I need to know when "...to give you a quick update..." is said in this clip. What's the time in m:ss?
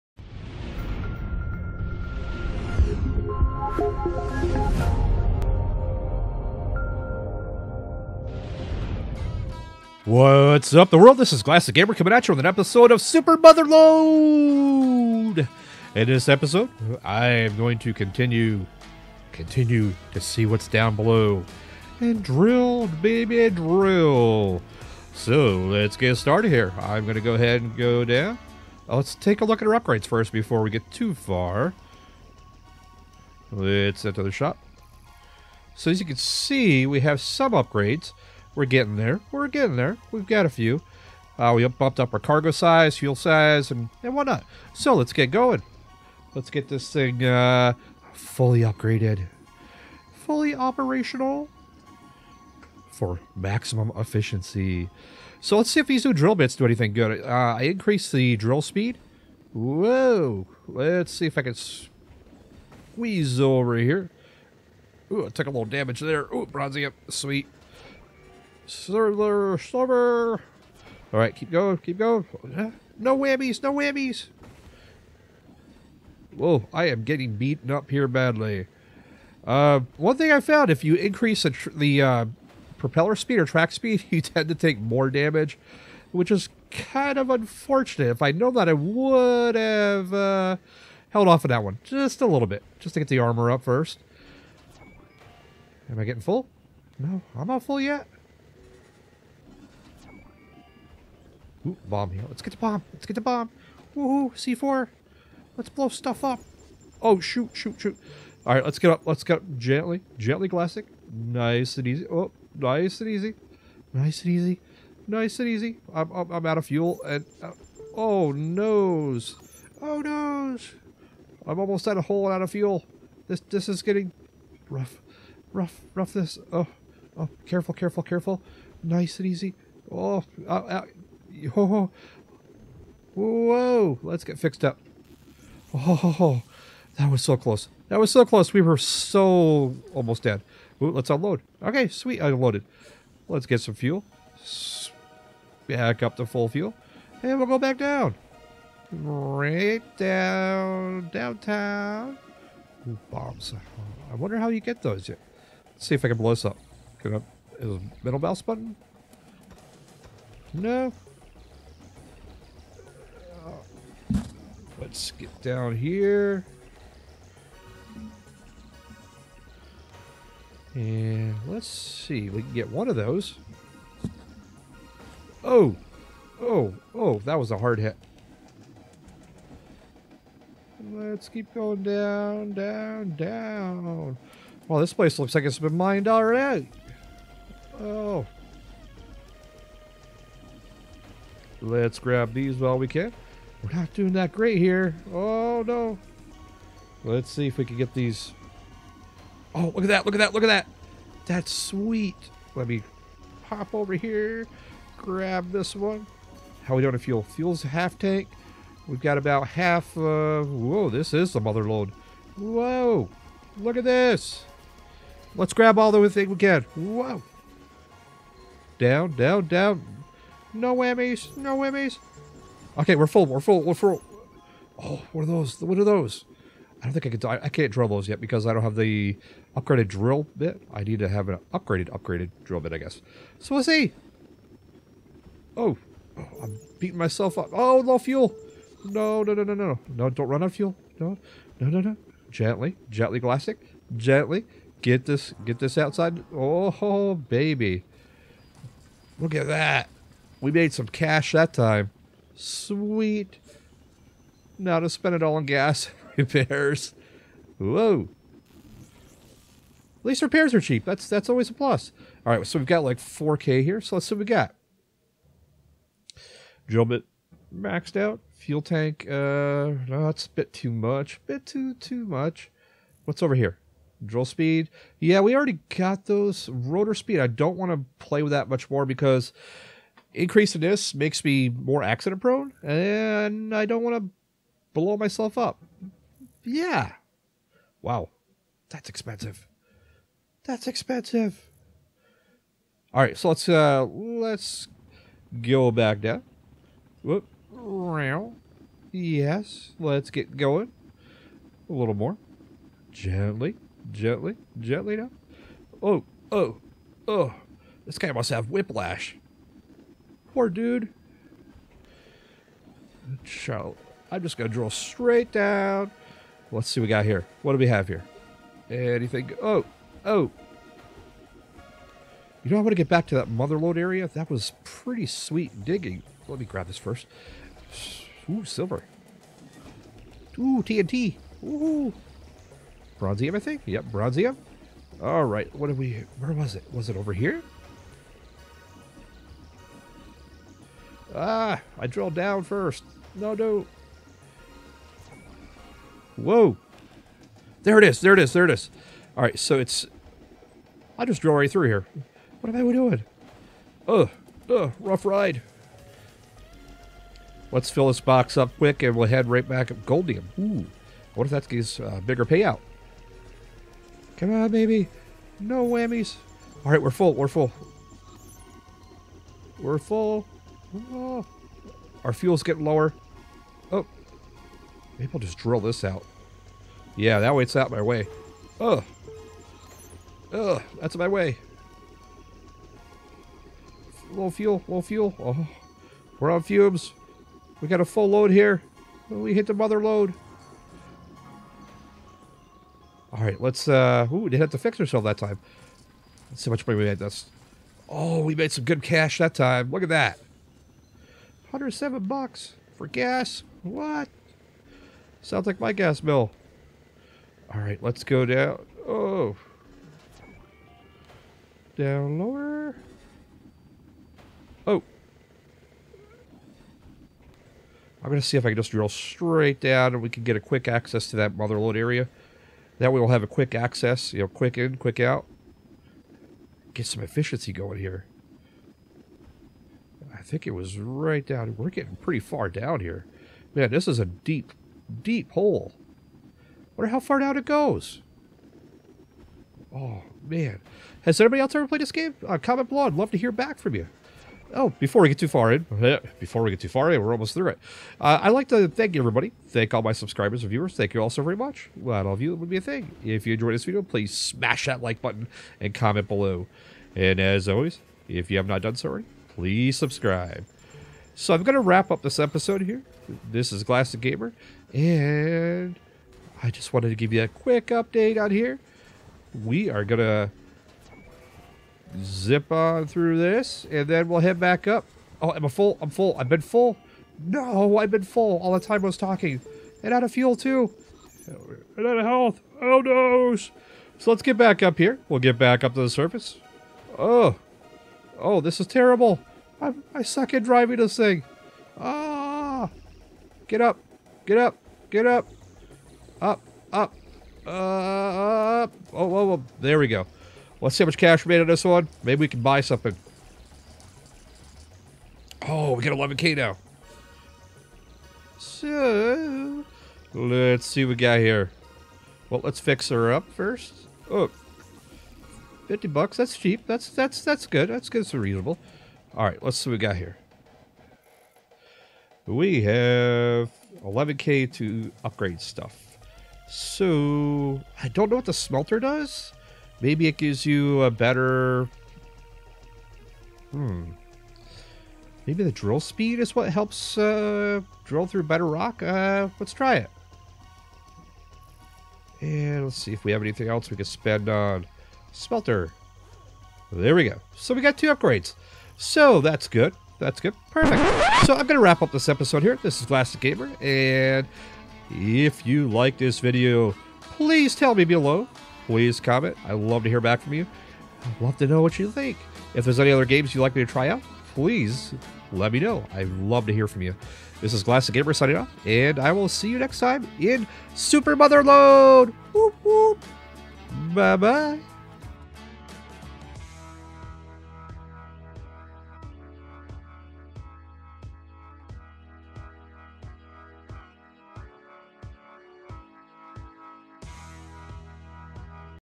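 7:46.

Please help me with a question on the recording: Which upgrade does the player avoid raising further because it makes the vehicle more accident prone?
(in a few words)
Rotor speed.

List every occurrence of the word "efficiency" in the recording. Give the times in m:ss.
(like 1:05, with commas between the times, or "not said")
0:53, 7:07.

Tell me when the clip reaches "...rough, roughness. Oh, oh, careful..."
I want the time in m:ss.
2:05.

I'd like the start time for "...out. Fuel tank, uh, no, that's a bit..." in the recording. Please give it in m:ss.
4:27.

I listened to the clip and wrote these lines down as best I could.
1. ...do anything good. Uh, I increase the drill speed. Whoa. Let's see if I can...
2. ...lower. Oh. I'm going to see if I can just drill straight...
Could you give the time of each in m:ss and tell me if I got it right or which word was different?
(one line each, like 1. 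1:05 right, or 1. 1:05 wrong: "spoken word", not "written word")
1. 0:56 right
2. 6:52 right.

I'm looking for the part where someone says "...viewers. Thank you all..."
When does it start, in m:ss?
7:30.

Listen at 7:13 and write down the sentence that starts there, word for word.
Man, this is a deep, deep hole.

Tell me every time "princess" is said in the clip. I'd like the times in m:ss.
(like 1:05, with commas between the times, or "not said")
not said.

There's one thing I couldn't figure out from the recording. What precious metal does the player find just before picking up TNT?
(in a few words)
silver.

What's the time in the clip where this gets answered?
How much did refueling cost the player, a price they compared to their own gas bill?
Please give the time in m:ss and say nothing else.
6:41.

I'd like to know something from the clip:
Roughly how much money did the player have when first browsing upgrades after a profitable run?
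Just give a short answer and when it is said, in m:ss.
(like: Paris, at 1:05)
4K, at 4:22.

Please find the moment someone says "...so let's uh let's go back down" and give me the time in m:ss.
4:53.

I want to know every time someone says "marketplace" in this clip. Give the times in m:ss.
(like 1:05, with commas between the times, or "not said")
not said.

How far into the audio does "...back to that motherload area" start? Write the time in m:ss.
5:22.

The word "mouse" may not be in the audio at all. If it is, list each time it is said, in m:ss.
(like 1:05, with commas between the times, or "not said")
2:38.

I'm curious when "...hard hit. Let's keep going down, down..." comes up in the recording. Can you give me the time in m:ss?
2:57.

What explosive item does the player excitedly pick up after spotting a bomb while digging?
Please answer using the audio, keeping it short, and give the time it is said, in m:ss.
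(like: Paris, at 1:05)
C4, at 1:44.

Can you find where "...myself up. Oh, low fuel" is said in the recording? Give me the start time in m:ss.
3:56.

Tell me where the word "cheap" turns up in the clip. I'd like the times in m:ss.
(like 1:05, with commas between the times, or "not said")
4:20, 8:36.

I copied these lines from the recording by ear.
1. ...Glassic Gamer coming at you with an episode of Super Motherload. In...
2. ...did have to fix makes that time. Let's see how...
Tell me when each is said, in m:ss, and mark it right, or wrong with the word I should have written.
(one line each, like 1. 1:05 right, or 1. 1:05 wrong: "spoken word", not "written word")
1. 0:11 right
2. 6:34 wrong: "ourselves", not "makes".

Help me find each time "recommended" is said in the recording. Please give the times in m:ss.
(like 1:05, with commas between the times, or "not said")
not said.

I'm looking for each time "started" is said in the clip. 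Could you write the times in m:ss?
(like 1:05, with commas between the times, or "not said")
0:26.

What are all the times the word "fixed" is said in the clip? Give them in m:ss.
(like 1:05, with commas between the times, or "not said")
2:14.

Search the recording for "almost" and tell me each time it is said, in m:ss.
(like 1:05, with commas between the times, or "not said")
2:01, 2:19, 7:27.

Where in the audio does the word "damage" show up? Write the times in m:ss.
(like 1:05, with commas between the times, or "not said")
1:05, 1:25.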